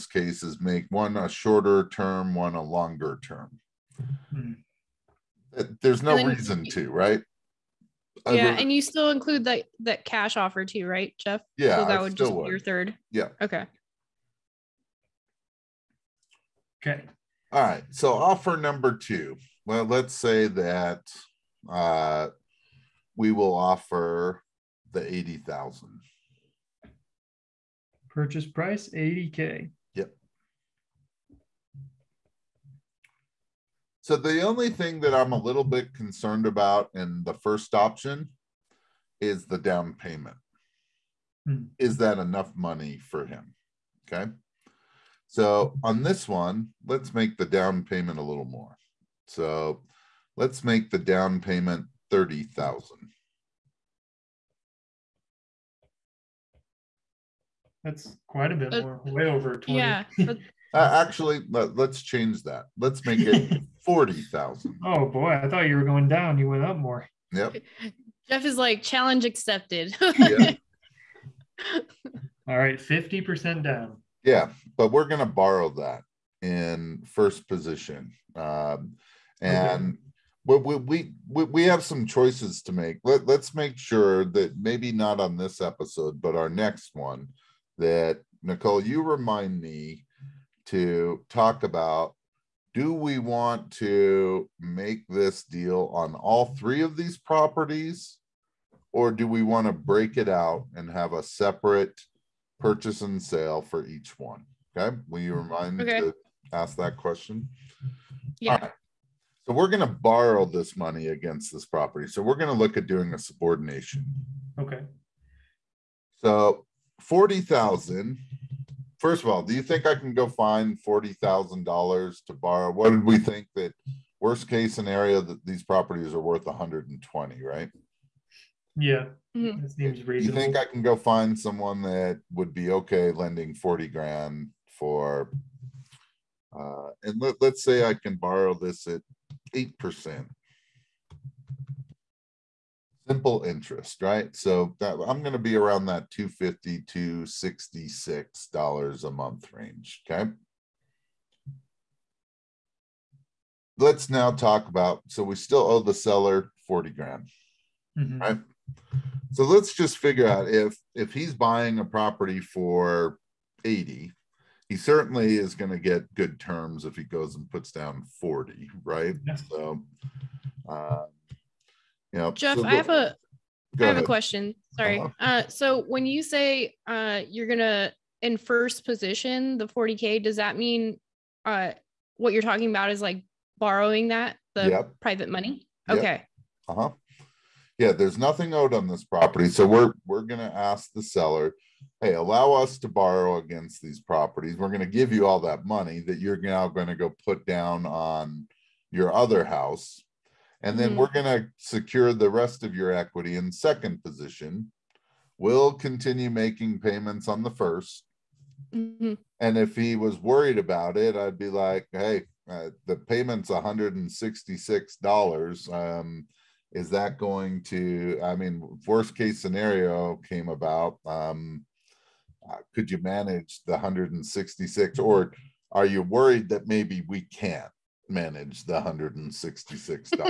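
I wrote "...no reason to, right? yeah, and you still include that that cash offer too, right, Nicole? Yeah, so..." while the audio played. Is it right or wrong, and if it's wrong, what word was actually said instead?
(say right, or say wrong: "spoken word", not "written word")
wrong: "Jeff", not "Nicole".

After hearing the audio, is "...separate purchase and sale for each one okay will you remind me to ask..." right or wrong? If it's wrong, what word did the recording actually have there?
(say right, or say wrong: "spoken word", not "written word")
right.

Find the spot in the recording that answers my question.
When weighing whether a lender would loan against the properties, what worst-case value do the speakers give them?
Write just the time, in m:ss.
2:06.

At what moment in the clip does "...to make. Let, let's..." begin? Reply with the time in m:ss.
1:22.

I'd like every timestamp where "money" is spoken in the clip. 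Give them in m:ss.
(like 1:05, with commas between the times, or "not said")
0:42, 1:50, 3:05, 3:15.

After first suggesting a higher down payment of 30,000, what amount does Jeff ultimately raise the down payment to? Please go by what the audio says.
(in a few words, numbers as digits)
$40,000.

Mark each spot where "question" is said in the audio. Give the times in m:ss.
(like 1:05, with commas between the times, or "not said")
1:46, 2:54.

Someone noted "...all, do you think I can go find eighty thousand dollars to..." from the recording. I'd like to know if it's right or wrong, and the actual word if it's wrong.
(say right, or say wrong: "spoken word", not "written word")
wrong: "forty", not "eighty".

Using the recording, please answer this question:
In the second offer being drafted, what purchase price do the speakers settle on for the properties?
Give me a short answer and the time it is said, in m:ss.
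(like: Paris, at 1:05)
$80,000, at 0:28.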